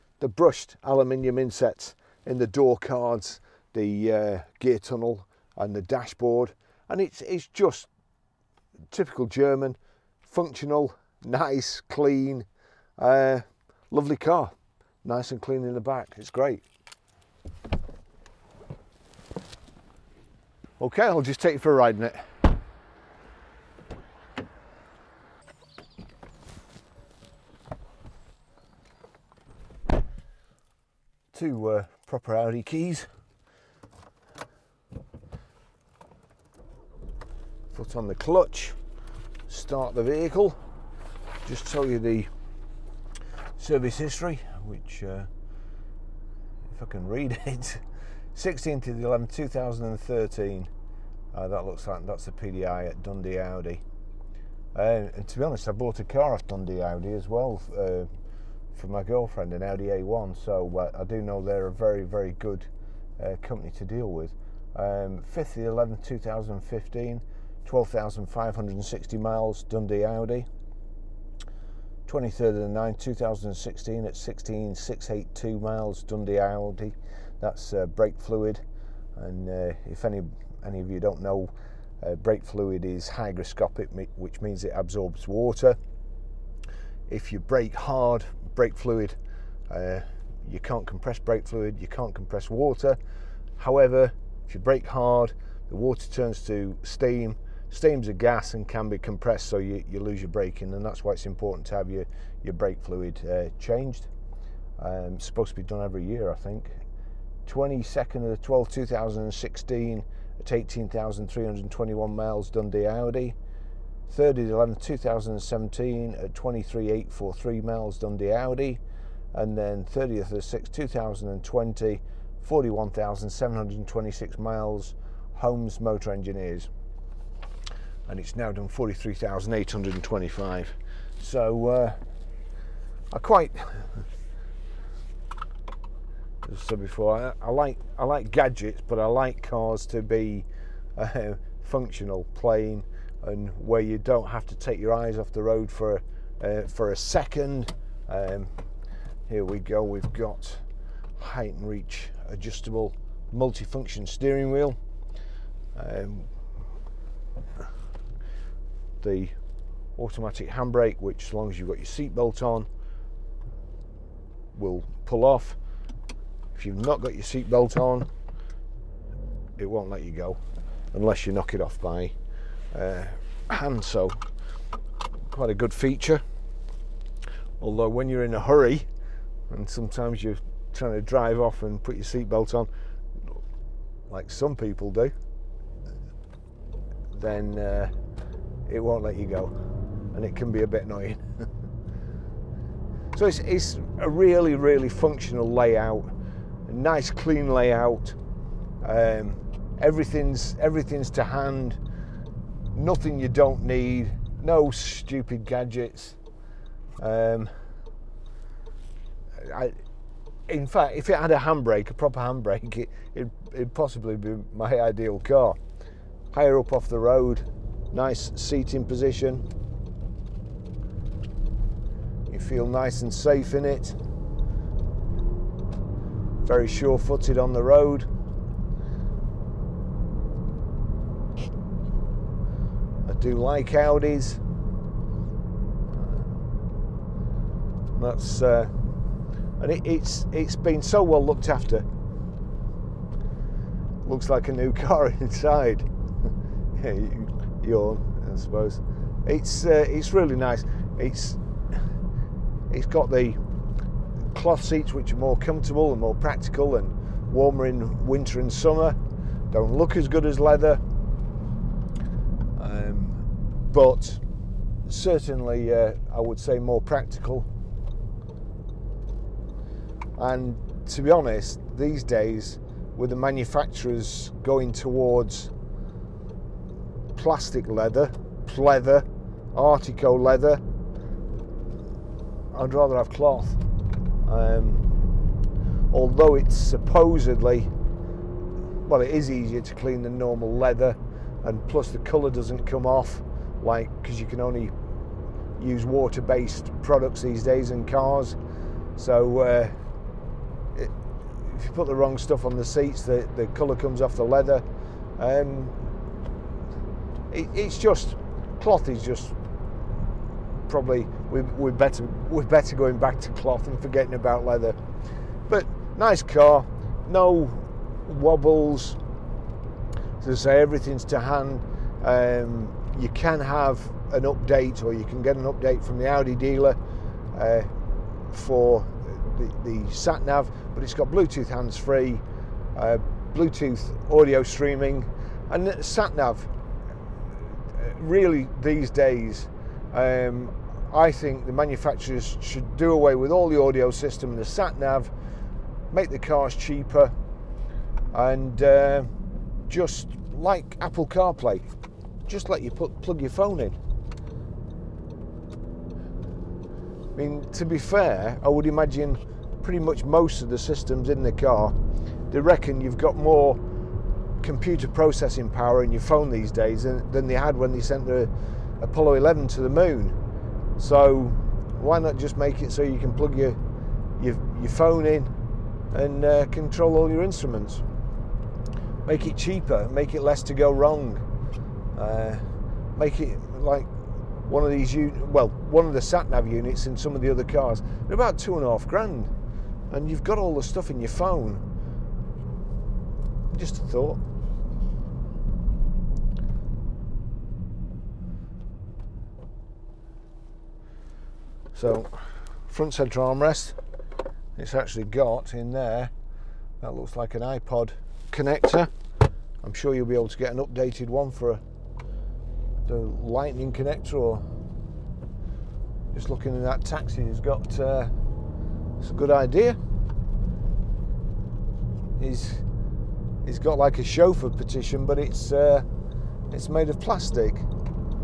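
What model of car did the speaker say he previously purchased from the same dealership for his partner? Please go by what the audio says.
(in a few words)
Audi A1.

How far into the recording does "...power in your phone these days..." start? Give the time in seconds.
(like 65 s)
365 s.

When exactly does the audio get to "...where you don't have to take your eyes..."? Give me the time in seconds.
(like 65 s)
143 s.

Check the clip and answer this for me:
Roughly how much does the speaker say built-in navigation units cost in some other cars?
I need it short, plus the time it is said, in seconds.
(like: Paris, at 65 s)
two and a half grand, at 388 s.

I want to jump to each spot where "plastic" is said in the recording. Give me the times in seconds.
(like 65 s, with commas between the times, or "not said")
277 s, 427 s.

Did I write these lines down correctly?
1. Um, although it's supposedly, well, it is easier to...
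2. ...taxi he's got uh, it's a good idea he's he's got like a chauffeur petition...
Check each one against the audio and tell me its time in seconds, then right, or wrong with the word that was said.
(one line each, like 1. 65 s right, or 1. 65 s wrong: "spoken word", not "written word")
1. 284 s right
2. 416 s right.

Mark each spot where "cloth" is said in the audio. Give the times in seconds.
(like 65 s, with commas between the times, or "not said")
254 s, 283 s, 308 s, 313 s.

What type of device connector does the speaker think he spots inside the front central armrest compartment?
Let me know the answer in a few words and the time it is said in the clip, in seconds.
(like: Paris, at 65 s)
iPod connector, at 407 s.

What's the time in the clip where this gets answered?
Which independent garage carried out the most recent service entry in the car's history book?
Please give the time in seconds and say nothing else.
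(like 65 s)
125 s.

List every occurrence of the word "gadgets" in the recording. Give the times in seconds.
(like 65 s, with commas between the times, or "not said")
138 s, 205 s.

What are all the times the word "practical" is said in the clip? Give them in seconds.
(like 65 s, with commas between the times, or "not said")
256 s, 266 s.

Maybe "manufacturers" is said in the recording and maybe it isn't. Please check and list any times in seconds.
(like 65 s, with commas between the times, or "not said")
273 s, 341 s.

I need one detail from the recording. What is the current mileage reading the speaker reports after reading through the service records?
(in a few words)
43,825.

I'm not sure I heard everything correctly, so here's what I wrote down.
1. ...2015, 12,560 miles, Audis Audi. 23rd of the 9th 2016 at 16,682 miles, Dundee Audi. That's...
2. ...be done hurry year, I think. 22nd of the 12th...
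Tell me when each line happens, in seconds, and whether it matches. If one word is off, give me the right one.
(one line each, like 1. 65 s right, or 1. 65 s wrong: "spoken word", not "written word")
1. 66 s wrong: "Dundee", not "Audis"
2. 105 s wrong: "every", not "hurry".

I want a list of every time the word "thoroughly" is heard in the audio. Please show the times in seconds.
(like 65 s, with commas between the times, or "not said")
not said.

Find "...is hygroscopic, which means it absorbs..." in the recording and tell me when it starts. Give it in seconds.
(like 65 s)
82 s.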